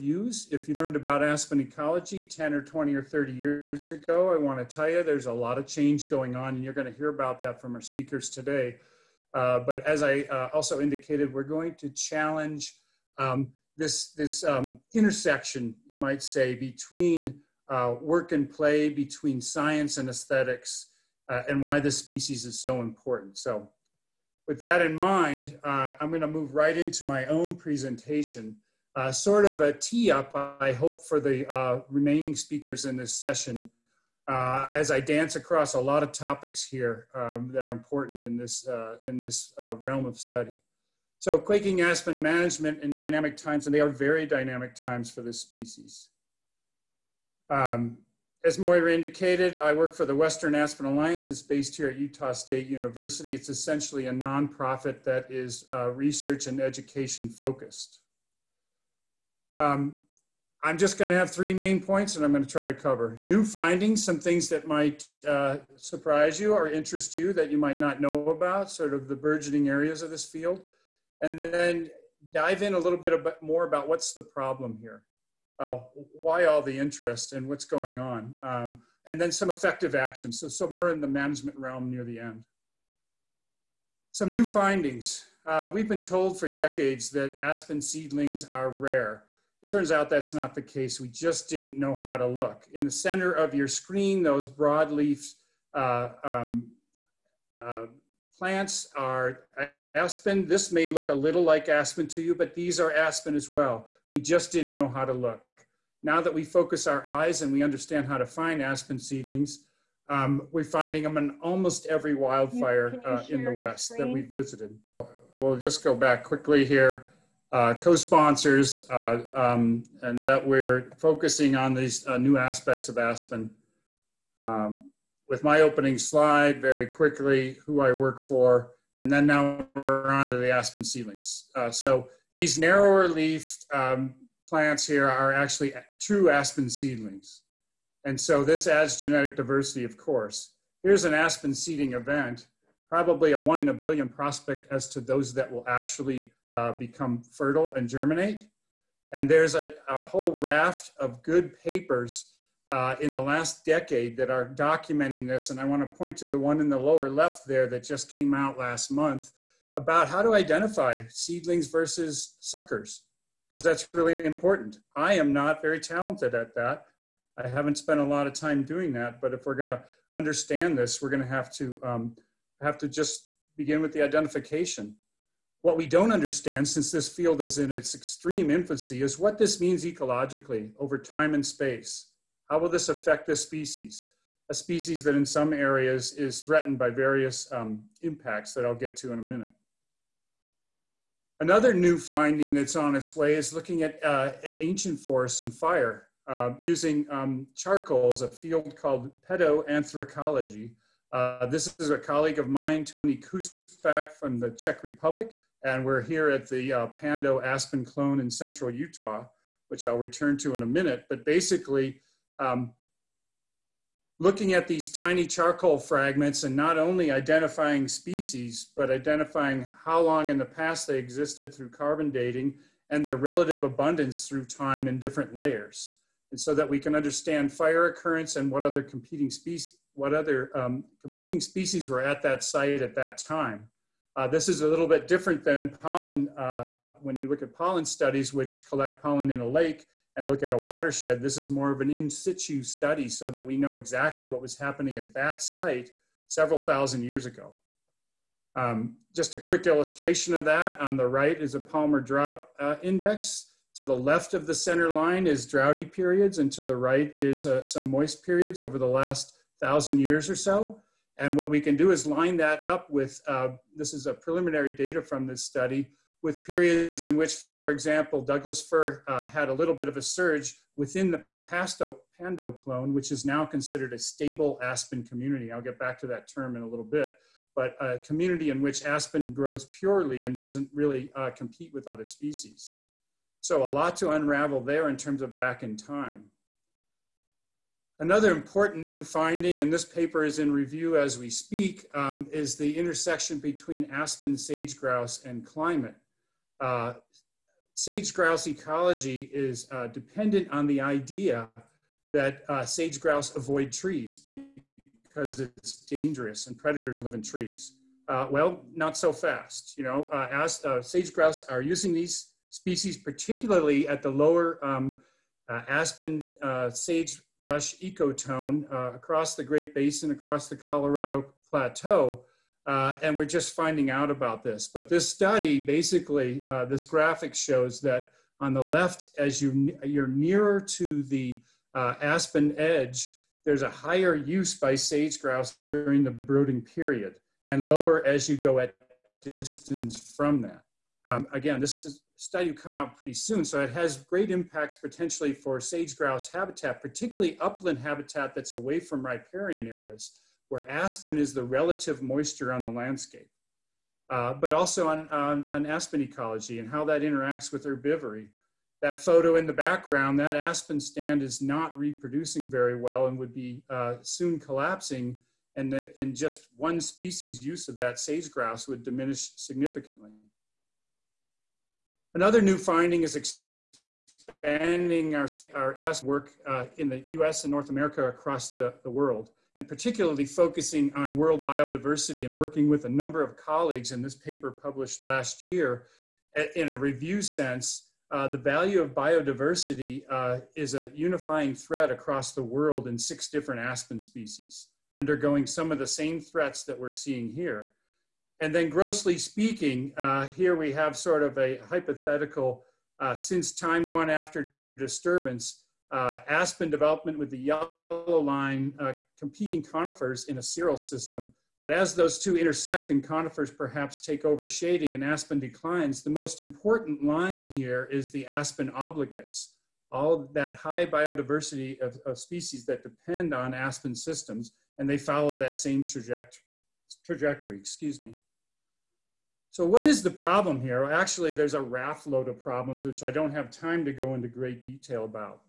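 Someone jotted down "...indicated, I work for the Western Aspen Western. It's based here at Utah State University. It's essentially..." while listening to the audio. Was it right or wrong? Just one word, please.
wrong.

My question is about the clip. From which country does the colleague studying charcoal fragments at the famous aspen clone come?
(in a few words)
Czech Republic.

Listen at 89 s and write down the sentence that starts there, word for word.
It turns out that's not the case.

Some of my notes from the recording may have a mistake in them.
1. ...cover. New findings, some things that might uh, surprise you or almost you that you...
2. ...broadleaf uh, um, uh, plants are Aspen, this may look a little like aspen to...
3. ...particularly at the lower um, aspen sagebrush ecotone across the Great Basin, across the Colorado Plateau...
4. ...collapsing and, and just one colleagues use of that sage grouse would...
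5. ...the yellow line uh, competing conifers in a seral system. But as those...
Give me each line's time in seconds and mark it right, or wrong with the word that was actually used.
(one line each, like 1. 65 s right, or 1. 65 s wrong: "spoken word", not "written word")
1. 62 s wrong: "interest", not "almost"
2. 94 s right
3. 312 s right
4. 364 s wrong: "species", not "colleagues"
5. 407 s right.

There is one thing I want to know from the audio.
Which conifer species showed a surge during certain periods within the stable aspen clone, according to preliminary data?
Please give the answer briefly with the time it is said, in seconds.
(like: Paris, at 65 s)
Douglas fir, at 268 s.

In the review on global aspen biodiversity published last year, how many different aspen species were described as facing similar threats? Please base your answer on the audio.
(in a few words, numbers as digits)
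6.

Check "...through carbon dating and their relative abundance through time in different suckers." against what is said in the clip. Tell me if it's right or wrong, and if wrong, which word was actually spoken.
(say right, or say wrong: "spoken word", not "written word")
wrong: "layers", not "suckers".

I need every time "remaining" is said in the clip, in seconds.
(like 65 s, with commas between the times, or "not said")
31 s.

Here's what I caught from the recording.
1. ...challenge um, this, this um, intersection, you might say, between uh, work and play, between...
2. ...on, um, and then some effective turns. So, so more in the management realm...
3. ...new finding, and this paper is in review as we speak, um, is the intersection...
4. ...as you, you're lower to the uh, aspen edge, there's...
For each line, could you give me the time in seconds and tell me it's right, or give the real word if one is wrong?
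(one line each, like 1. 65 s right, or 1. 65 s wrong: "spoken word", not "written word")
1. 11 s right
2. 77 s wrong: "actions", not "turns"
3. 288 s right
4. 329 s wrong: "nearer", not "lower".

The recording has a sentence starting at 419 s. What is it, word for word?
All of that high biodiversity of, of species that depend on aspen systems, and they follow that same trajectory, excuse me.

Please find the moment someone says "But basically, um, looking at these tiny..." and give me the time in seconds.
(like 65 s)
211 s.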